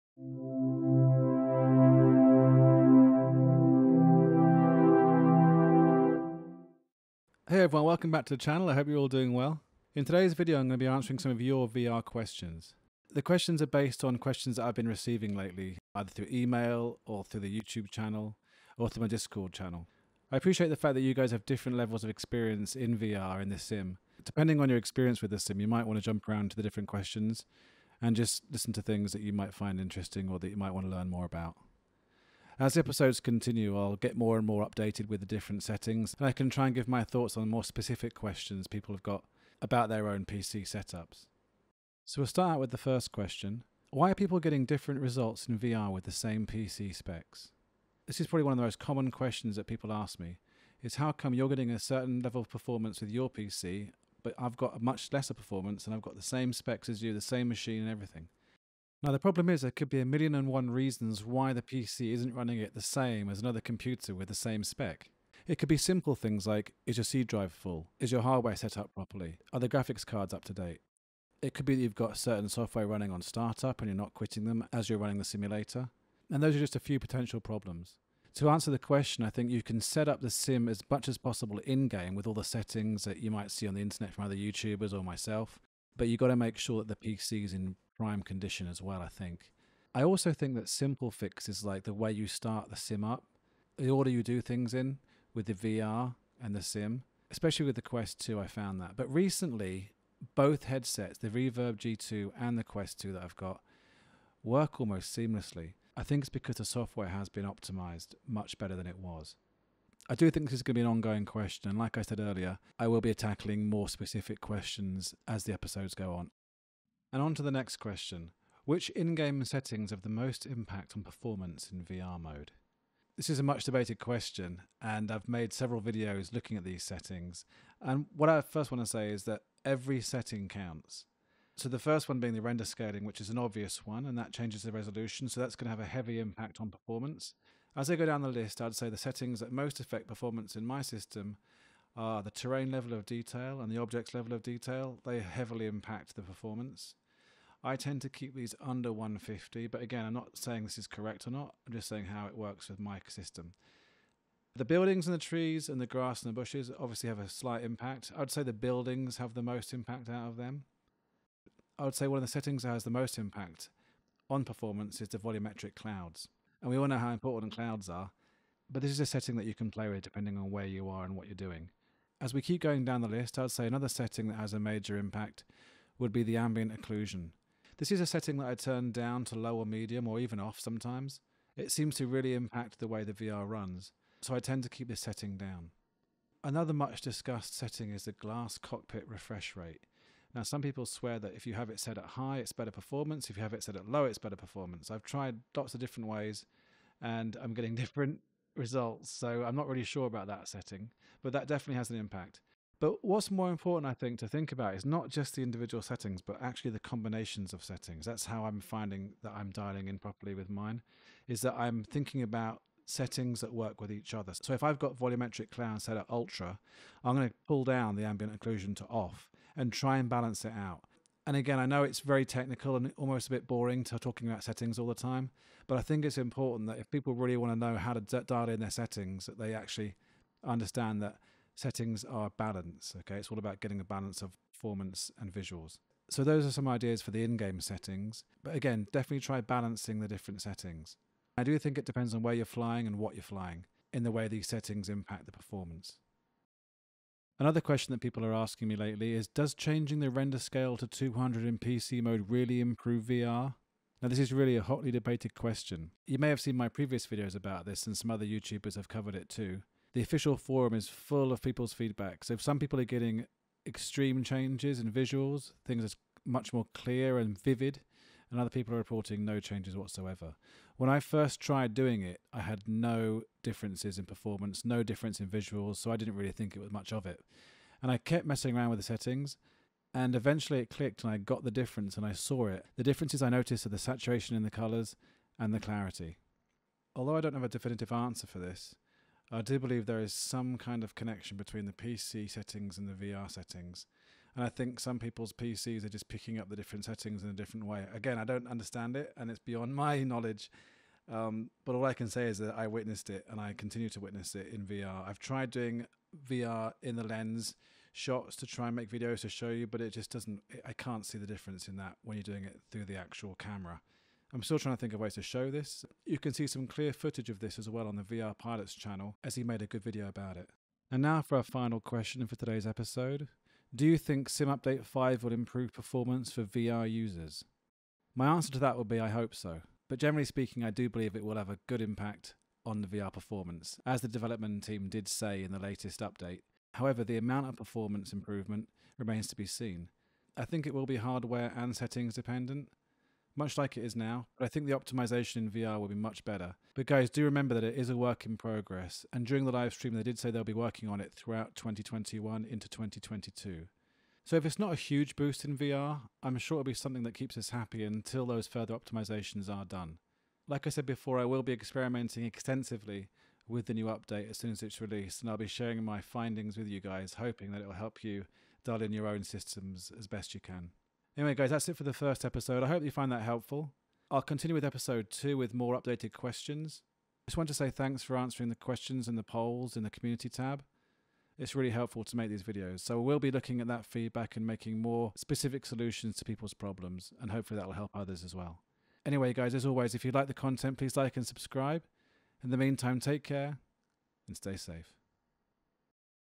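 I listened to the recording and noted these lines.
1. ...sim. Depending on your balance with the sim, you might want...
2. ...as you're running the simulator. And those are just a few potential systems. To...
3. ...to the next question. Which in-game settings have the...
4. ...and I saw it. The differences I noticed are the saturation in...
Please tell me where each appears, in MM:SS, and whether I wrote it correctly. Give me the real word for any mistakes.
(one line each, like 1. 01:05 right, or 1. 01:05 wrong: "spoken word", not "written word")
1. 00:23 wrong: "experience", not "balance"
2. 01:14 wrong: "problems", not "systems"
3. 01:57 right
4. 04:41 right.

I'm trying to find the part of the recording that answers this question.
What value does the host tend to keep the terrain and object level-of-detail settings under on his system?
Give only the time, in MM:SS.
02:28.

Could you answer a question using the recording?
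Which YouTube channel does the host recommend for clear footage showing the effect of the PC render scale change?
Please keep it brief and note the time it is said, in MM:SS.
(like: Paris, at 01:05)
VR Pilots, at 05:18.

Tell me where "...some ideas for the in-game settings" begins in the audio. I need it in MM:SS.
03:56.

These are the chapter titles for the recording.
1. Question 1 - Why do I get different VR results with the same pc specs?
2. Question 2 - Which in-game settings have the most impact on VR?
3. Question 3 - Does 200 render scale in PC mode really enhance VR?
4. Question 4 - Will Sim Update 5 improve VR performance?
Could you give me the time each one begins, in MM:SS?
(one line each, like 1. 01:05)
1. 00:42
2. 01:58
3. 04:09
4. 05:23.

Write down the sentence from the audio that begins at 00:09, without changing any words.
In today's video, I'm going to be answering some of your VR questions.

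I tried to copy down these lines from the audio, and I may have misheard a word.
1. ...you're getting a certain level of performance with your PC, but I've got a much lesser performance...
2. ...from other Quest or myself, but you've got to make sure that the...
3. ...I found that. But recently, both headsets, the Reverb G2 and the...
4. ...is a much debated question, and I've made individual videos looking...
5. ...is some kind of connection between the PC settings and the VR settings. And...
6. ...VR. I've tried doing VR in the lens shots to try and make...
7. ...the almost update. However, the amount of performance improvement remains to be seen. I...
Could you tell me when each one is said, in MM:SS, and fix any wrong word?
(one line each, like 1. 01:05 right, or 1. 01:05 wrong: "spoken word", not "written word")
1. 00:51 right
2. 01:24 wrong: "YouTubers", not "Quest"
3. 01:38 right
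4. 02:03 wrong: "several", not "individual"
5. 04:50 right
6. 05:04 right
7. 05:35 wrong: "latest", not "almost".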